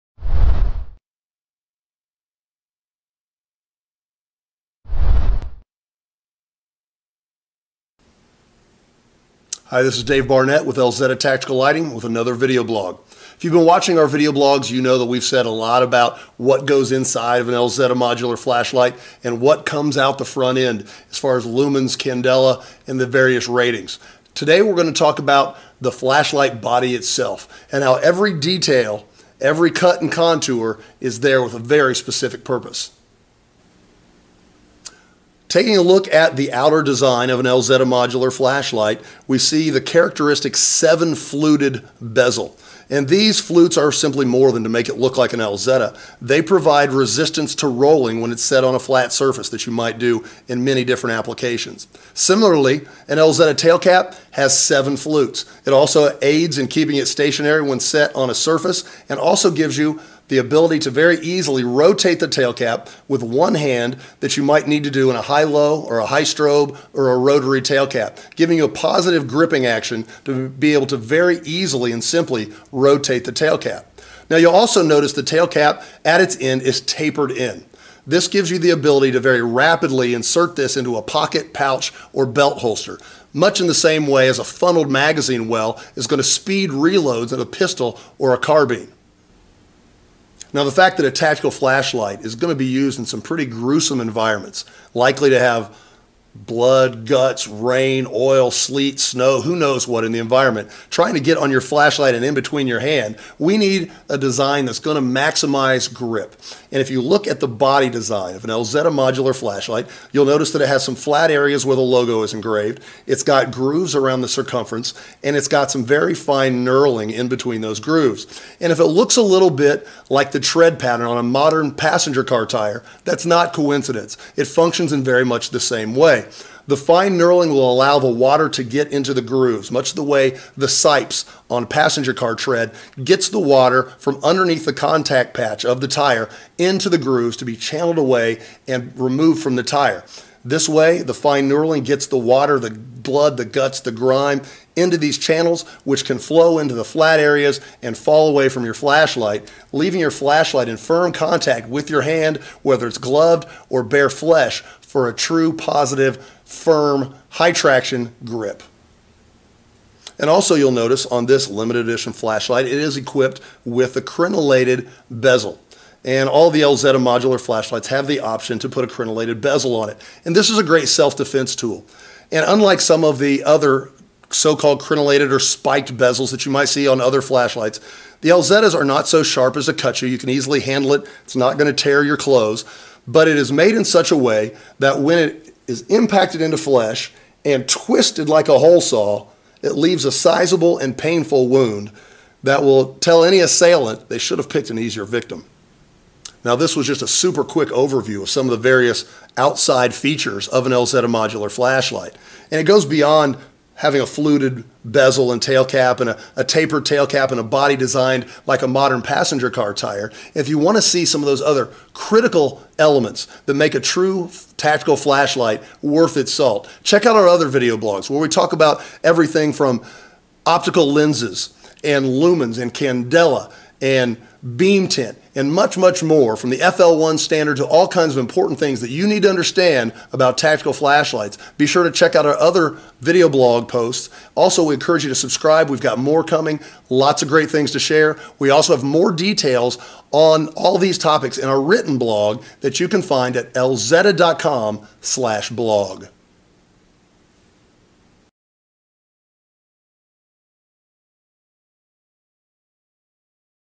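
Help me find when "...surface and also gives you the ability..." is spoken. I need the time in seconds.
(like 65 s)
58 s.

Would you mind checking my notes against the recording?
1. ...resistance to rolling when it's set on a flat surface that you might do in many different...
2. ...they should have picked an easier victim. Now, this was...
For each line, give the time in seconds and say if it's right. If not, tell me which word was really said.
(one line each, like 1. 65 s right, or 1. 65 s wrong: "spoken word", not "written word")
1. 46 s right
2. 194 s right.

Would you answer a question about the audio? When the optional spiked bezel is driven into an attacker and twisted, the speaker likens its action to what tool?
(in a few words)
hole saw.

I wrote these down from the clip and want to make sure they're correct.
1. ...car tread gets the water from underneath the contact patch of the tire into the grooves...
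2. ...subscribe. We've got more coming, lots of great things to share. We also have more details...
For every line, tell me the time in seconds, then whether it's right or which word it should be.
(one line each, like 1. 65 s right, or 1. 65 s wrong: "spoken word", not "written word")
1. 132 s right
2. 235 s right.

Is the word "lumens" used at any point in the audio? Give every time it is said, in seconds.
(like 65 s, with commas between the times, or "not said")
21 s, 222 s.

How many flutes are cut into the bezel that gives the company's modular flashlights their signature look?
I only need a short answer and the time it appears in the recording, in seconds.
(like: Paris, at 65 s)
7, at 40 s.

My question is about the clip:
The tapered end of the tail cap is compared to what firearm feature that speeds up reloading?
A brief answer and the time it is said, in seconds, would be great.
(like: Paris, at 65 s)
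funneled magazine well, at 84 s.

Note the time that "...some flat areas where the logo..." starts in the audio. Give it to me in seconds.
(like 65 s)
110 s.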